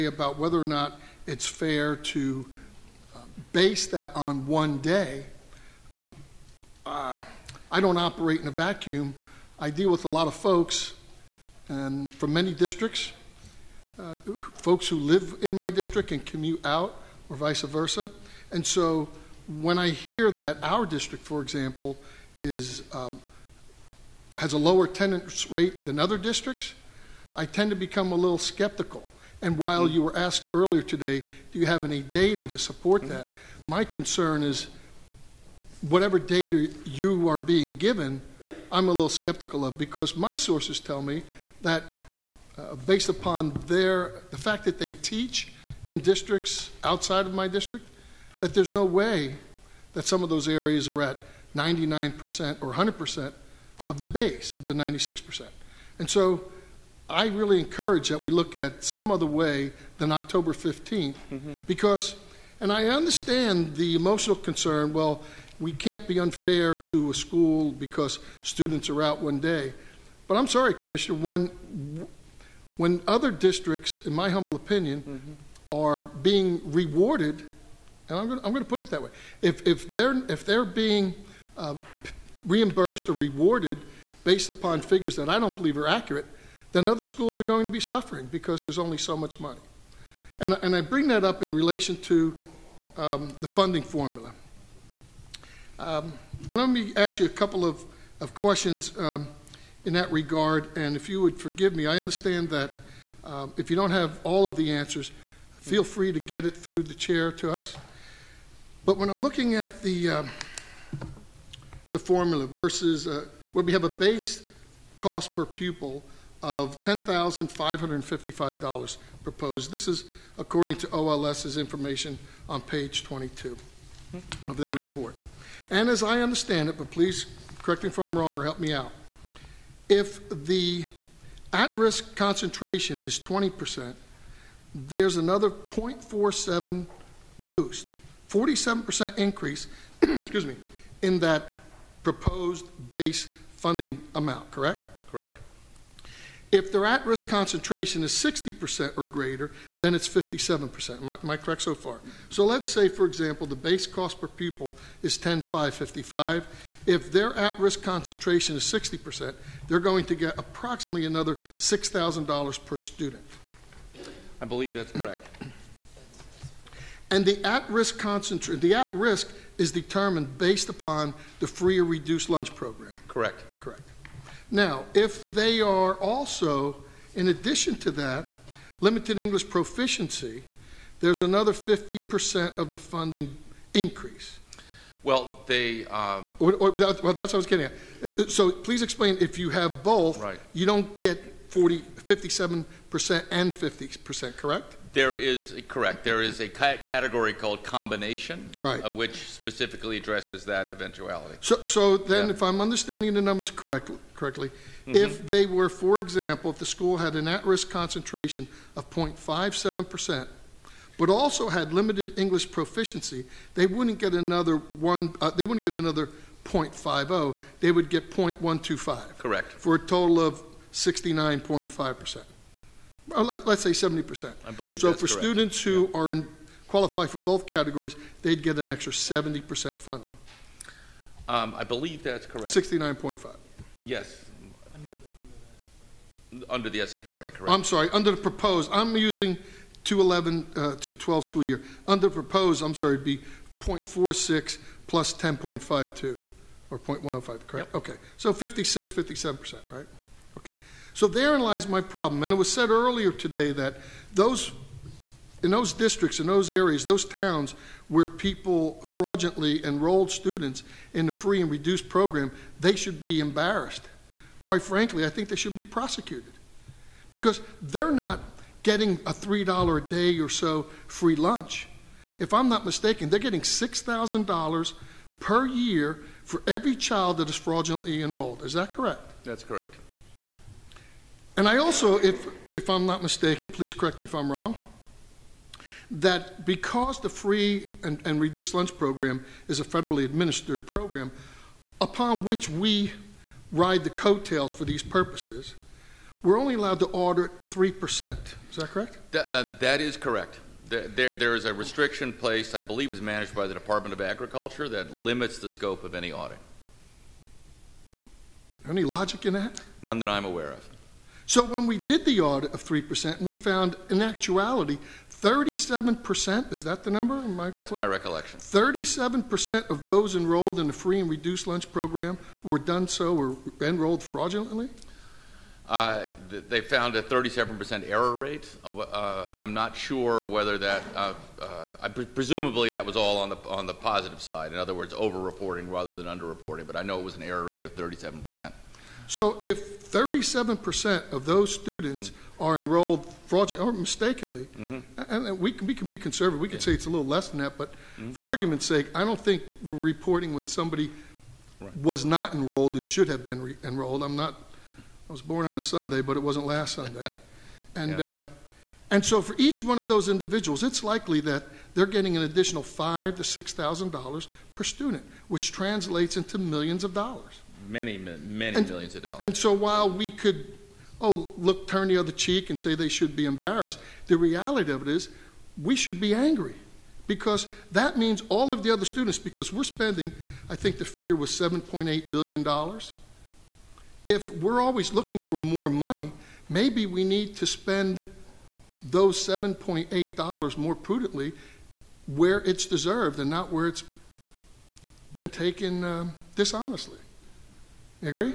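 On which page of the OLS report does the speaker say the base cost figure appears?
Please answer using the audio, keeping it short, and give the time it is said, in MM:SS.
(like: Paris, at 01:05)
22, at 02:02.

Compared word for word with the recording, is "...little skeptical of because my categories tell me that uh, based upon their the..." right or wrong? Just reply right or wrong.
wrong.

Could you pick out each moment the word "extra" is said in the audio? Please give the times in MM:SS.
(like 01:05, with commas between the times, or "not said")
03:48.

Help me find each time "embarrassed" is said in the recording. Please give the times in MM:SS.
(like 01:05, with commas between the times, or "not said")
04:23, 06:13.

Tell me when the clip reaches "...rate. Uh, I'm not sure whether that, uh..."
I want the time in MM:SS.
05:28.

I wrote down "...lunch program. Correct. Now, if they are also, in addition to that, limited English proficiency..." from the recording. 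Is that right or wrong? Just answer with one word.
right.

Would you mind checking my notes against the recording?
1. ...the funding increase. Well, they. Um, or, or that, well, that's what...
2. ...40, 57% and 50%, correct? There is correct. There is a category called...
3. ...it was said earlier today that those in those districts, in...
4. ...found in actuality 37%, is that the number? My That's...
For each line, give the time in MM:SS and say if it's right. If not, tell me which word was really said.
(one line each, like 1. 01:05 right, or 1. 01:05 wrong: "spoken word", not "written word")
1. 03:02 right
2. 03:11 right
3. 04:12 right
4. 05:13 right.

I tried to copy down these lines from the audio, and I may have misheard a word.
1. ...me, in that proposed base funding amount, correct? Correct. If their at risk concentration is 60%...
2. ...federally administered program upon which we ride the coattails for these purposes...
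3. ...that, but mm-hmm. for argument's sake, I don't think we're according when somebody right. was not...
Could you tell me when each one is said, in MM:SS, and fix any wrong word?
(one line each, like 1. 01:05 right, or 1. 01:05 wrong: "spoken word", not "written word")
1. 02:20 right
2. 04:49 right
3. 05:47 wrong: "reporting", not "according".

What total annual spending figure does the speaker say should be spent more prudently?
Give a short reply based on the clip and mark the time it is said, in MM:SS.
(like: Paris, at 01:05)
$7.8 billion, at 06:21.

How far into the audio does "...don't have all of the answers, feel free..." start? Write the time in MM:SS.
01:43.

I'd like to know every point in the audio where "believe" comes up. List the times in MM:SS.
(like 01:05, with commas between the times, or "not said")
01:25, 02:44, 03:44, 03:51, 05:02.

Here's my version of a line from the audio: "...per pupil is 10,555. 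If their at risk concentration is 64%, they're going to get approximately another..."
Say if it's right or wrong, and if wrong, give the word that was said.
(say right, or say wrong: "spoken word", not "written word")
wrong: "60", not "64".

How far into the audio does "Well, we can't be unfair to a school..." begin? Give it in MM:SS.
01:04.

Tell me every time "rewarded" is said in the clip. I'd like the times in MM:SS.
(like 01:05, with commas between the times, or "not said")
01:16, 01:23.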